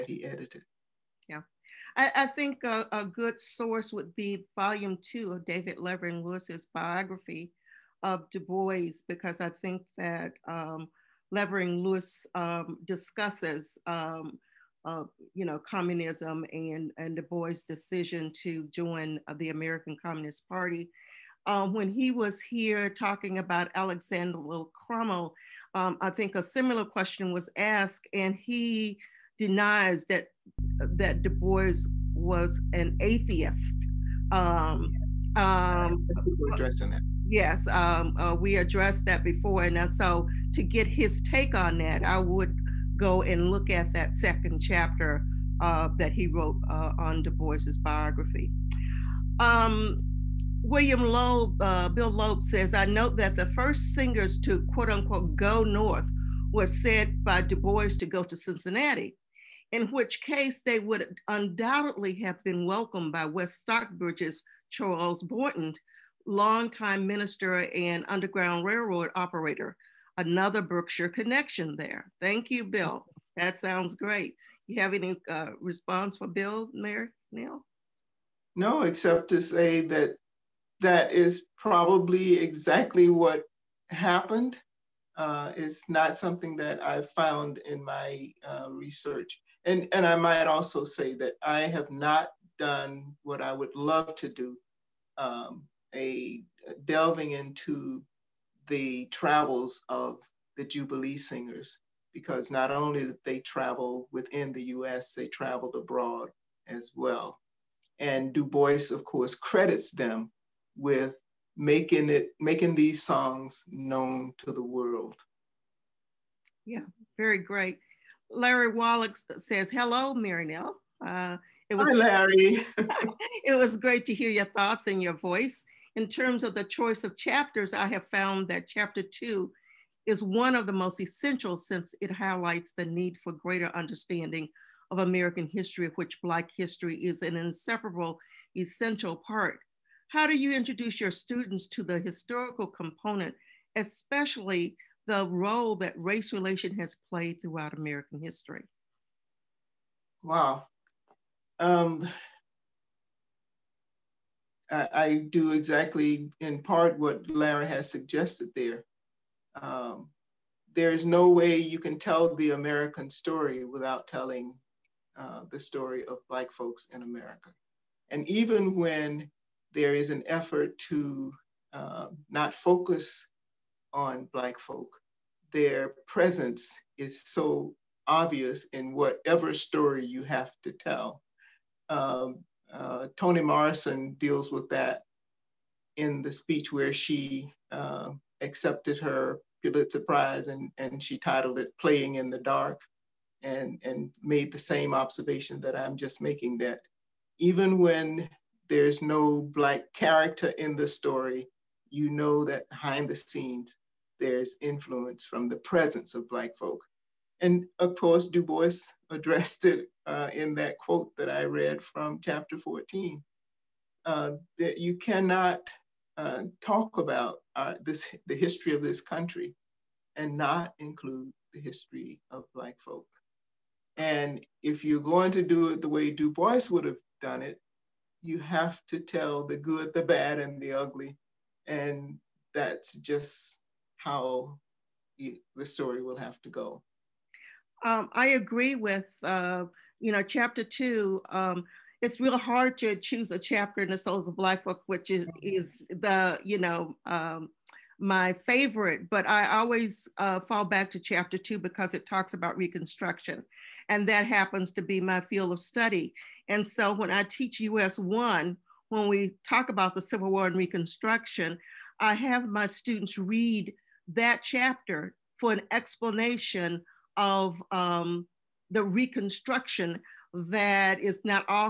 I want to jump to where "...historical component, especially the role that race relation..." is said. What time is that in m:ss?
2:21.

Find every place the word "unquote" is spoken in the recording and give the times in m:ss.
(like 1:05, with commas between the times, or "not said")
0:54.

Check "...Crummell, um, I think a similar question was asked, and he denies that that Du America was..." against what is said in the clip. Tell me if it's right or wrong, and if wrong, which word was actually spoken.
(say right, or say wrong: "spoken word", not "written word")
wrong: "Bois", not "America".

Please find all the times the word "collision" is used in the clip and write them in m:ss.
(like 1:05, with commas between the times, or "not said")
not said.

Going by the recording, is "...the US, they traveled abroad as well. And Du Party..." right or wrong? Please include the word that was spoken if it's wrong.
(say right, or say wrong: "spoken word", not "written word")
wrong: "Bois", not "Party".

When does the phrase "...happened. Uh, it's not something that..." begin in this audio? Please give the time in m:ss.
1:23.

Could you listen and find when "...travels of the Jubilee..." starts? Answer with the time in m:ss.
1:39.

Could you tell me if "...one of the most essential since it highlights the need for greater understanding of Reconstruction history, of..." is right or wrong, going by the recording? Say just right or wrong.
wrong.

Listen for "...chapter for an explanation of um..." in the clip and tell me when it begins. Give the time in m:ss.
4:24.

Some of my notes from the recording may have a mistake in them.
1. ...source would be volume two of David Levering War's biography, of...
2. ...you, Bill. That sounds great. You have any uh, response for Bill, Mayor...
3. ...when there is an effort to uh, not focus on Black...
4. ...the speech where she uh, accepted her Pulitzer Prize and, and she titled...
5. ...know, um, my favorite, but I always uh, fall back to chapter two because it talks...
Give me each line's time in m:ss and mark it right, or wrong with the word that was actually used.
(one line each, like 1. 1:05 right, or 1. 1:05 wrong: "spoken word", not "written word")
1. 0:03 wrong: "Lewis", not "War"
2. 1:12 right
3. 2:48 right
4. 3:06 right
5. 4:06 right.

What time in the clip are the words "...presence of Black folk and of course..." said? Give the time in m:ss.
3:25.